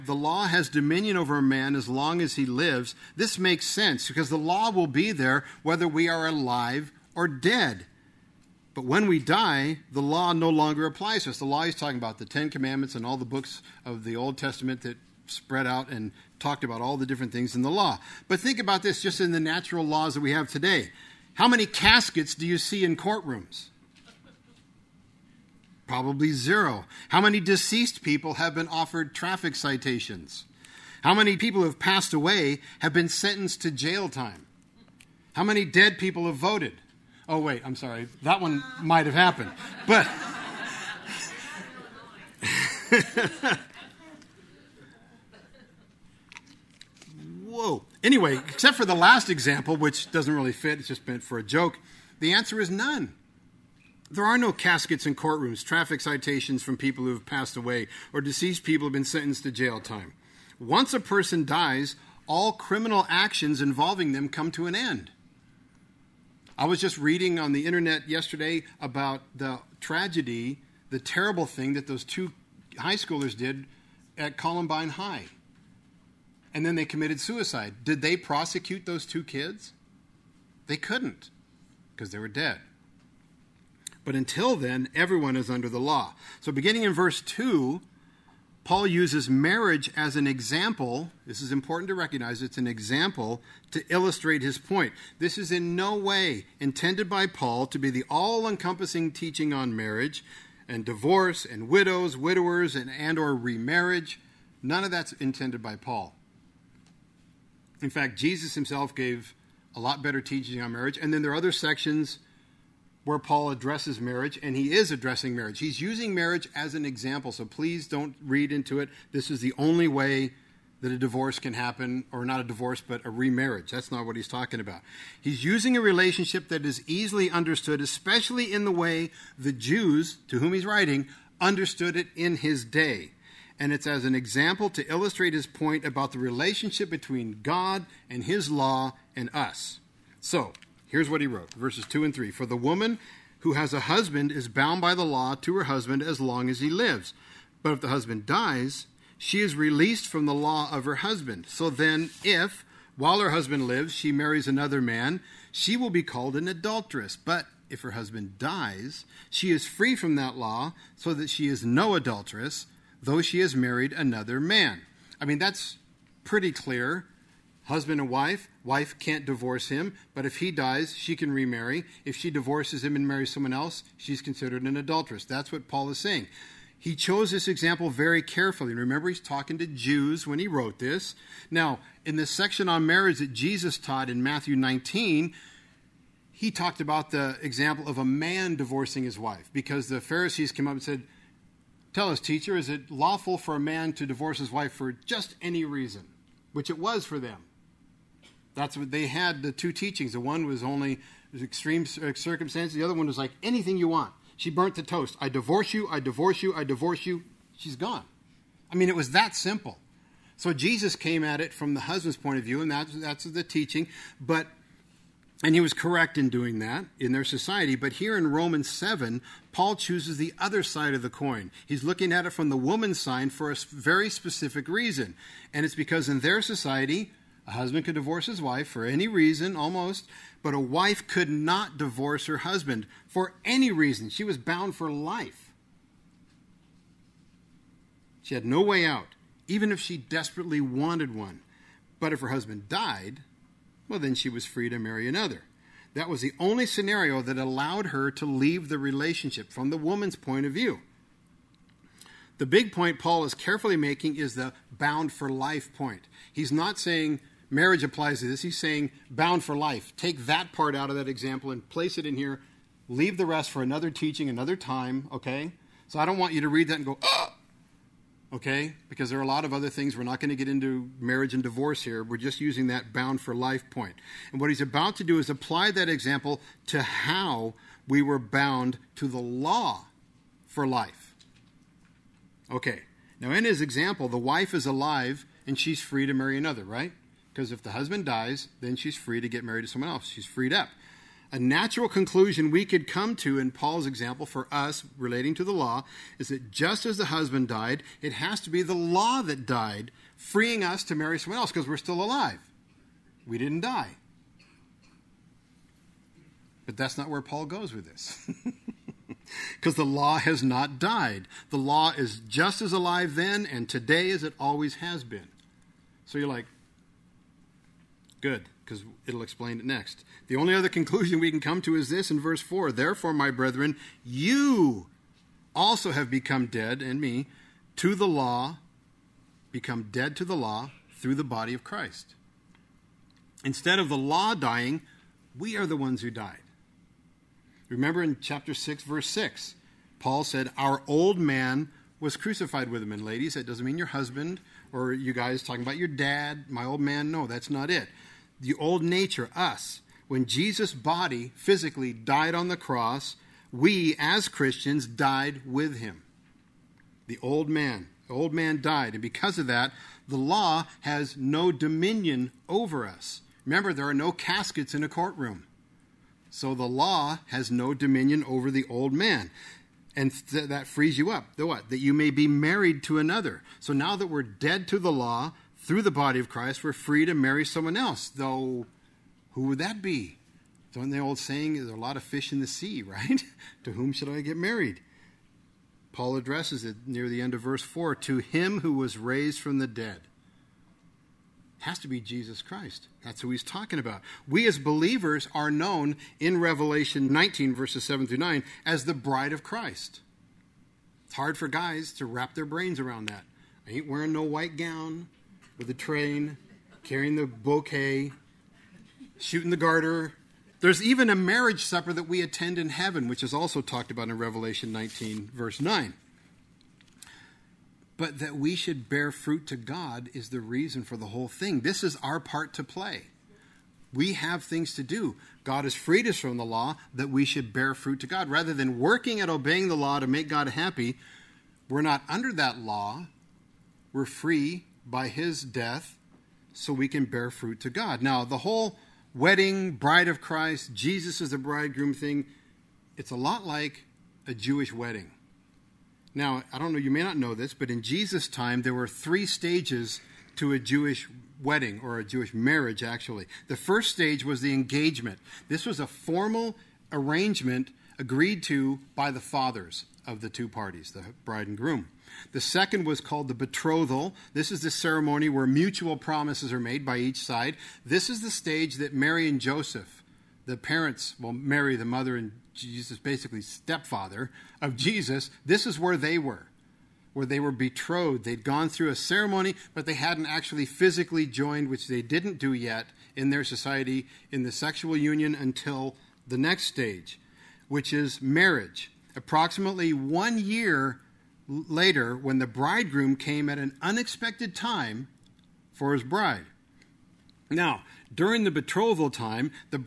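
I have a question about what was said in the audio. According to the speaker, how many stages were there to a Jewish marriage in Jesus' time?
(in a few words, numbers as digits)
3.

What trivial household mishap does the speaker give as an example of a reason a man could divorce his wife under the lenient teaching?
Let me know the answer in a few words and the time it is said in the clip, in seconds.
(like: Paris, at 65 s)
She burnt the toast, at 204 s.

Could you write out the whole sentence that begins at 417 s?
But that we should bear fruit to God is the reason for the whole thing.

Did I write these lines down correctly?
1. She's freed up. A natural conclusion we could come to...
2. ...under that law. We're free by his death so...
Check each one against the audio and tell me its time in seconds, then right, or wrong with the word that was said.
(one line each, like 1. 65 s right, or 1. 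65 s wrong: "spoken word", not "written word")
1. 290 s right
2. 432 s right.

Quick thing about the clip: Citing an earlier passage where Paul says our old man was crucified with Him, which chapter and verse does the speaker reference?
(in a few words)
Chapter 6, verse 6.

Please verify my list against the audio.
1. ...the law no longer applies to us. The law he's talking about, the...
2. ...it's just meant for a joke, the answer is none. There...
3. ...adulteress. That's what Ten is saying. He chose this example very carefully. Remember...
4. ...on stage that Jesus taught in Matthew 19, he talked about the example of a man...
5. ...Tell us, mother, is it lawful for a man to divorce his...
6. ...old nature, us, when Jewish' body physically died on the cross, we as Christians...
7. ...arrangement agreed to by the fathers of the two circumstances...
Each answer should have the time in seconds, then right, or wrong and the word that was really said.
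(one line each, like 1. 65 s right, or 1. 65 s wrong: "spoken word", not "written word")
1. 9 s right
2. 50 s right
3. 174 s wrong: "Paul", not "Ten"
4. 182 s wrong: "marriage", not "stage"
5. 191 s wrong: "teacher", not "mother"
6. 348 s wrong: "Jesus", not "Jewish"
7. 456 s wrong: "parties", not "circumstances".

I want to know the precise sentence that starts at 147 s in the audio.
But if the husband dies, she is released from the law of her husband.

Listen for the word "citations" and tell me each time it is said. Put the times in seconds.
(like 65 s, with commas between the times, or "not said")
29 s, 55 s.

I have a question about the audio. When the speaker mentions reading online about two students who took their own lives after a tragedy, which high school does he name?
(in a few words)
Columbine High.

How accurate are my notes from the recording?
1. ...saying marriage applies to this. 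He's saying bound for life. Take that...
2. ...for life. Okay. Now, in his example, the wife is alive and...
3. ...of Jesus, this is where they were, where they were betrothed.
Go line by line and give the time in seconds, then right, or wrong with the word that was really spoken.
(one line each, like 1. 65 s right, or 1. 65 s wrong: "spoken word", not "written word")
1. 256 s right
2. 280 s right
3. 474 s right.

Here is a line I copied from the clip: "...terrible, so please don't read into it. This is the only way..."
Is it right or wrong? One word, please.
wrong.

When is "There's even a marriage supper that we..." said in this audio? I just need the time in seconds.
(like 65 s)
410 s.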